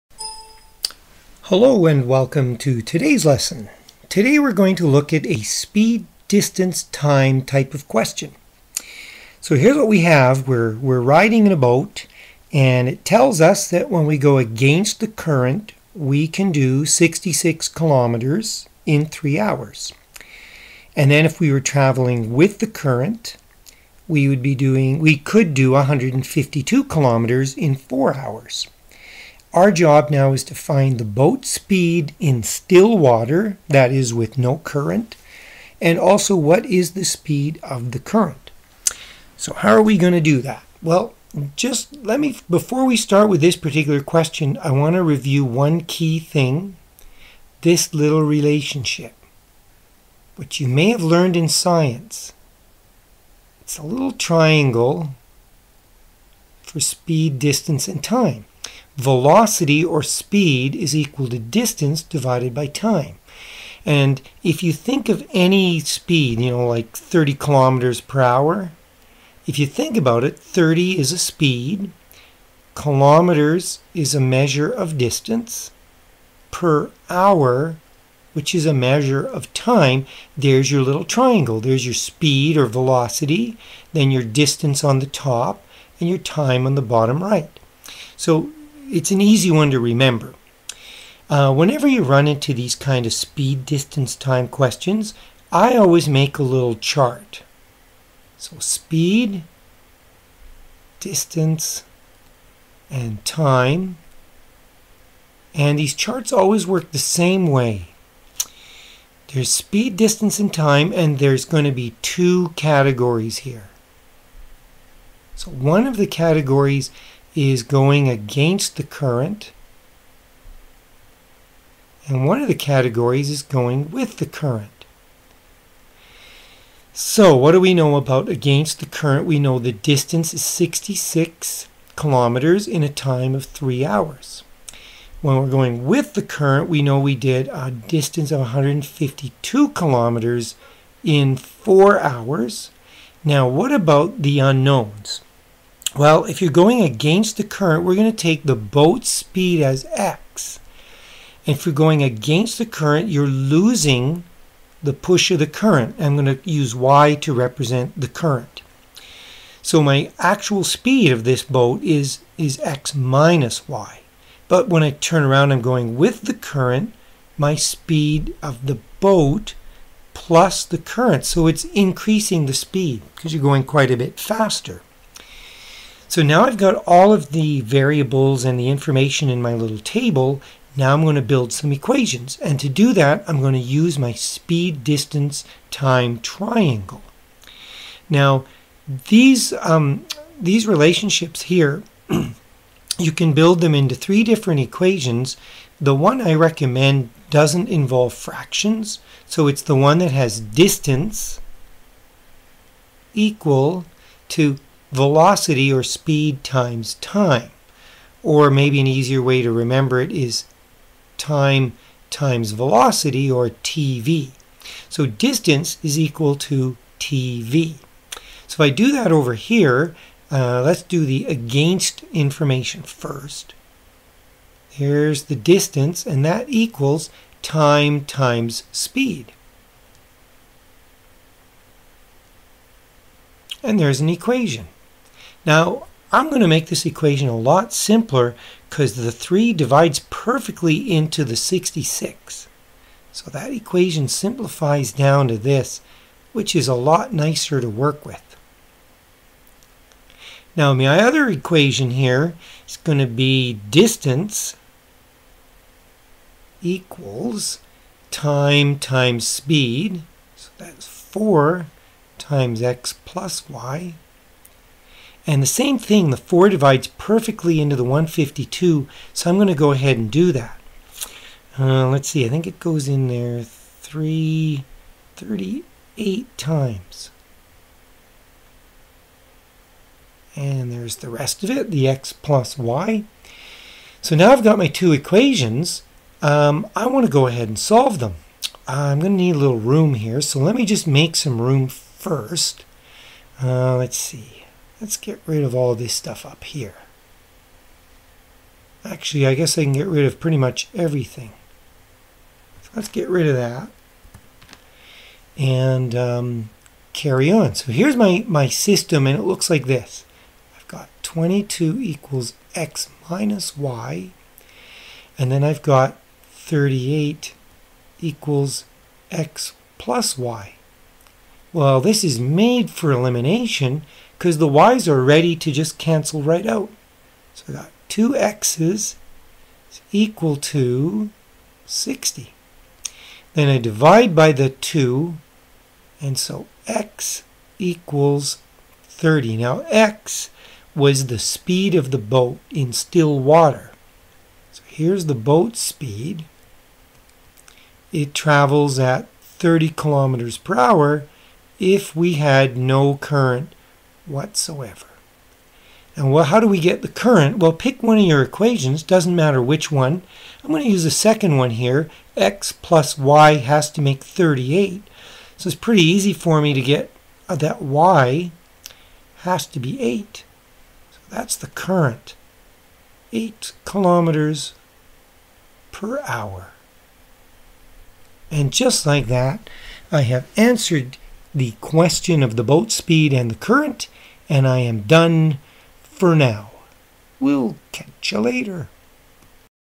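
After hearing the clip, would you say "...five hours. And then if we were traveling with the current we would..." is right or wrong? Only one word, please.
wrong.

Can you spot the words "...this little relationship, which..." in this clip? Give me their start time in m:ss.
0:47.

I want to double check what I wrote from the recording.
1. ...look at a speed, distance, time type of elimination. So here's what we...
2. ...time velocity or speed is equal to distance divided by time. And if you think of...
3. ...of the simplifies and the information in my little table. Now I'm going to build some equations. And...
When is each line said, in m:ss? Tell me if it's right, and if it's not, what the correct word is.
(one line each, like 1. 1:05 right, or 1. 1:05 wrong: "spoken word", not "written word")
1. 0:04 wrong: "question", not "elimination"
2. 0:58 right
3. 2:57 wrong: "variables", not "simplifies".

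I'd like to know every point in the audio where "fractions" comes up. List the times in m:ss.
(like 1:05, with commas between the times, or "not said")
3:18.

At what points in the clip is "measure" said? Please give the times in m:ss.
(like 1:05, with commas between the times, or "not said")
1:14, 1:18.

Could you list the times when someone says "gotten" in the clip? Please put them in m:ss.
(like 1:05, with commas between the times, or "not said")
not said.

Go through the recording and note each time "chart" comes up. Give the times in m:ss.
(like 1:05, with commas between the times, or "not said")
1:36, 1:45.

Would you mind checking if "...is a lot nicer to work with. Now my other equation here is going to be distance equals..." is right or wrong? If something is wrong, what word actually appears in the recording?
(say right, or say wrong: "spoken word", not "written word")
right.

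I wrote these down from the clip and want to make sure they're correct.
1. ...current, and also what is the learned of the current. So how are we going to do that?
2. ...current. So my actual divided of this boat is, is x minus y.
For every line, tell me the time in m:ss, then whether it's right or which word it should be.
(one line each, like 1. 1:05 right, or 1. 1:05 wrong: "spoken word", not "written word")
1. 0:34 wrong: "speed", not "learned"
2. 2:38 wrong: "speed", not "divided".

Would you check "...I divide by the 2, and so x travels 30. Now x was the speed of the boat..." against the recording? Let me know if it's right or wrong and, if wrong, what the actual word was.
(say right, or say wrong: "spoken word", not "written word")
wrong: "equals", not "travels".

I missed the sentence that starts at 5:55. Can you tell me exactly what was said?
And well, how do we get the current?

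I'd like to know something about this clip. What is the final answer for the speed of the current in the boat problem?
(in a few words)
8 kilometers per hour.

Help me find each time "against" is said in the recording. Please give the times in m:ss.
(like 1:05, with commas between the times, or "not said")
0:14, 1:58, 2:08, 2:26, 2:32, 3:41.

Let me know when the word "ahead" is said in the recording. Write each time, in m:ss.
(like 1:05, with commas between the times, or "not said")
4:29, 4:47.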